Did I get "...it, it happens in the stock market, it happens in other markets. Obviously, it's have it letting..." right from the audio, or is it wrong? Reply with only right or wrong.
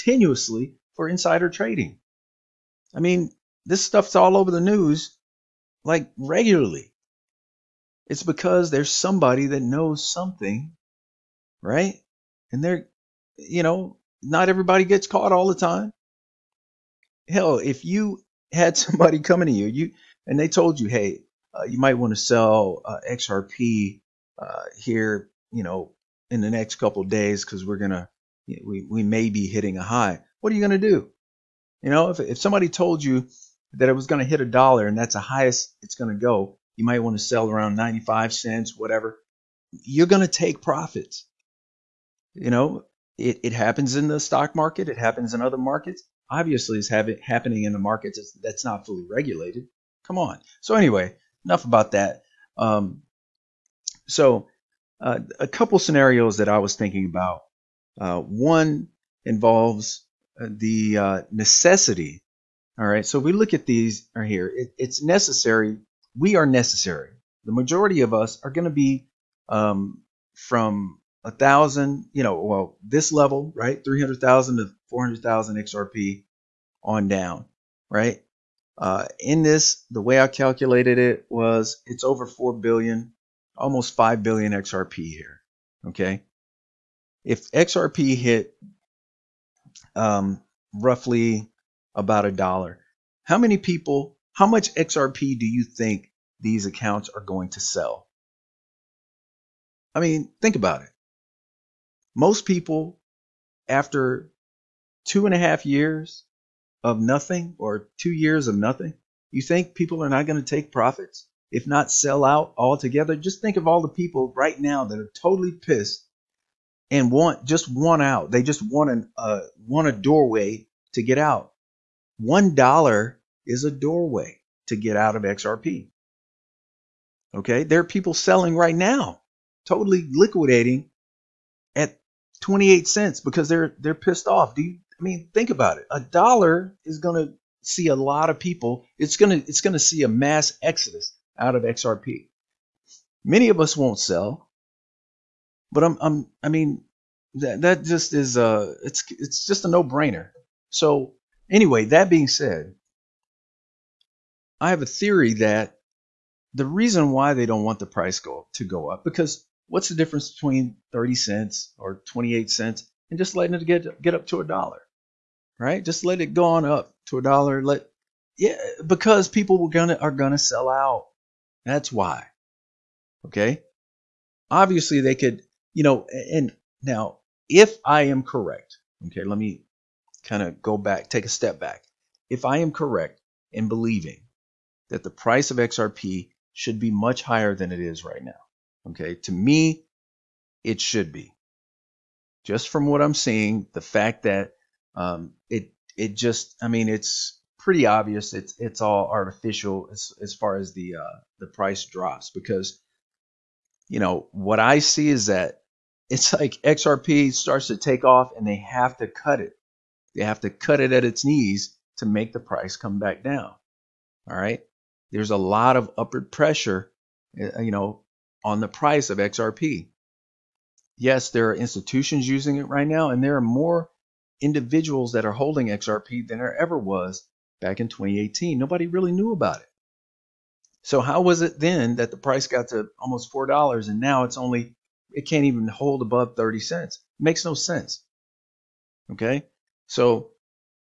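wrong.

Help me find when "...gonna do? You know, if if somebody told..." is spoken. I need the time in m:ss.
0:30.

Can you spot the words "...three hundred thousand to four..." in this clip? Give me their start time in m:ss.
1:13.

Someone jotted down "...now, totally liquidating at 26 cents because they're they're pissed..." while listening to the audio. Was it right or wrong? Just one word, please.
wrong.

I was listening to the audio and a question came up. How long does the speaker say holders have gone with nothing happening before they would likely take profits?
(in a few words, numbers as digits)
2 and a half years.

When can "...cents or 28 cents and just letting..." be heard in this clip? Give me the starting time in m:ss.
2:41.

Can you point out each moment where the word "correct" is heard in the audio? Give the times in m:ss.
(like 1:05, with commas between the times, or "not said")
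2:58, 3:02.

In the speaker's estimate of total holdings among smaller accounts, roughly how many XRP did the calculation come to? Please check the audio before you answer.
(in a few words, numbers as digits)
almost 5 billion.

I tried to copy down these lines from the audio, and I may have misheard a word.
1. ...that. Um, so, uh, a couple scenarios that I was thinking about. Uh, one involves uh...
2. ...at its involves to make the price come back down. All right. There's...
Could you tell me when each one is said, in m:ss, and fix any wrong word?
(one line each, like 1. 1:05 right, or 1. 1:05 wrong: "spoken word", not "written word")
1. 0:51 right
2. 3:30 wrong: "knees", not "involves".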